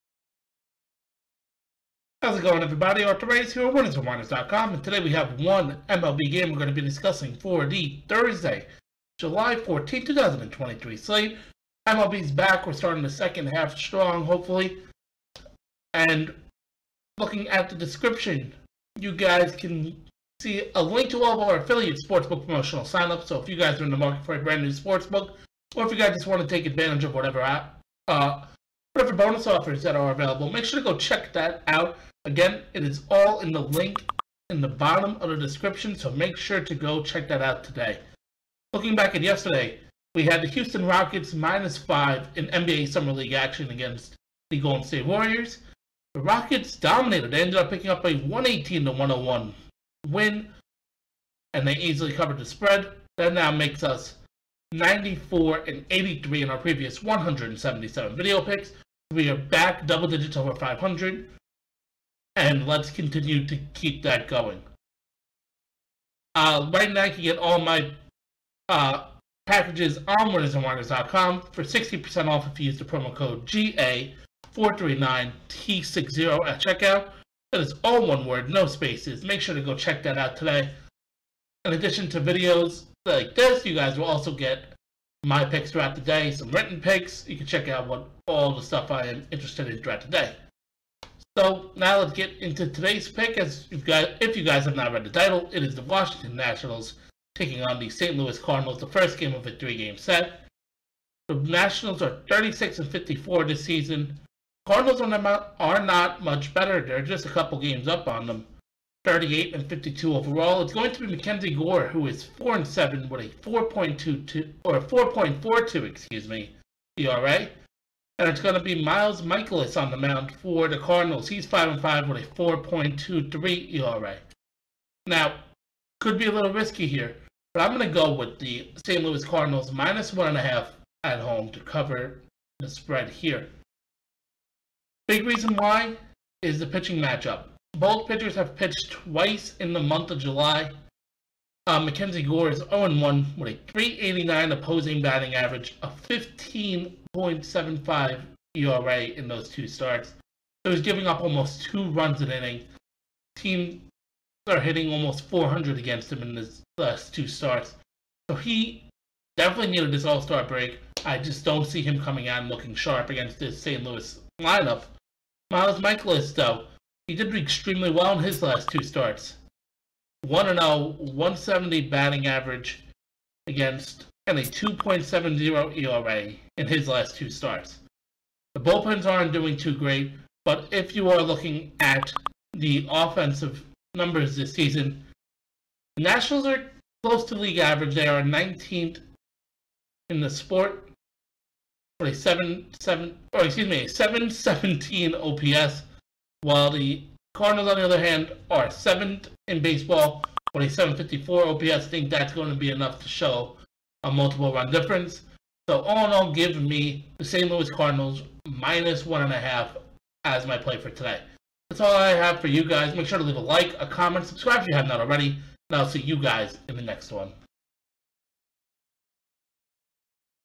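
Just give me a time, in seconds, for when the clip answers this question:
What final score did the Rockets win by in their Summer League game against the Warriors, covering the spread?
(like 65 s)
48 s.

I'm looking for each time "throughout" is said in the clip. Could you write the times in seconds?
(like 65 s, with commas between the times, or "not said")
85 s, 89 s.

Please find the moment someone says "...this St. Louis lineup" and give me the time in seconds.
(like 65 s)
163 s.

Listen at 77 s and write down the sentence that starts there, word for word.
That is all one word, no spaces.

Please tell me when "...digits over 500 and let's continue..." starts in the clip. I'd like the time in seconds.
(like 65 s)
60 s.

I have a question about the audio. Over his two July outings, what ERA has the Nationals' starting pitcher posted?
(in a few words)
15.75.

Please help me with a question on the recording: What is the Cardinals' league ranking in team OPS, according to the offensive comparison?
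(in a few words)
7th.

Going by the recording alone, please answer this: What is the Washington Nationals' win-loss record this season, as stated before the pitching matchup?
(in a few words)
36 and 54.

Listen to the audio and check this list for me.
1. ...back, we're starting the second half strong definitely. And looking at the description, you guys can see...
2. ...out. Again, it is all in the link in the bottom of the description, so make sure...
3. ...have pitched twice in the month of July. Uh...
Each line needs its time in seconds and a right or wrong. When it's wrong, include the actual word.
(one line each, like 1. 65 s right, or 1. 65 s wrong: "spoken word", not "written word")
1. 12 s wrong: "hopefully", not "definitely"
2. 31 s right
3. 138 s right.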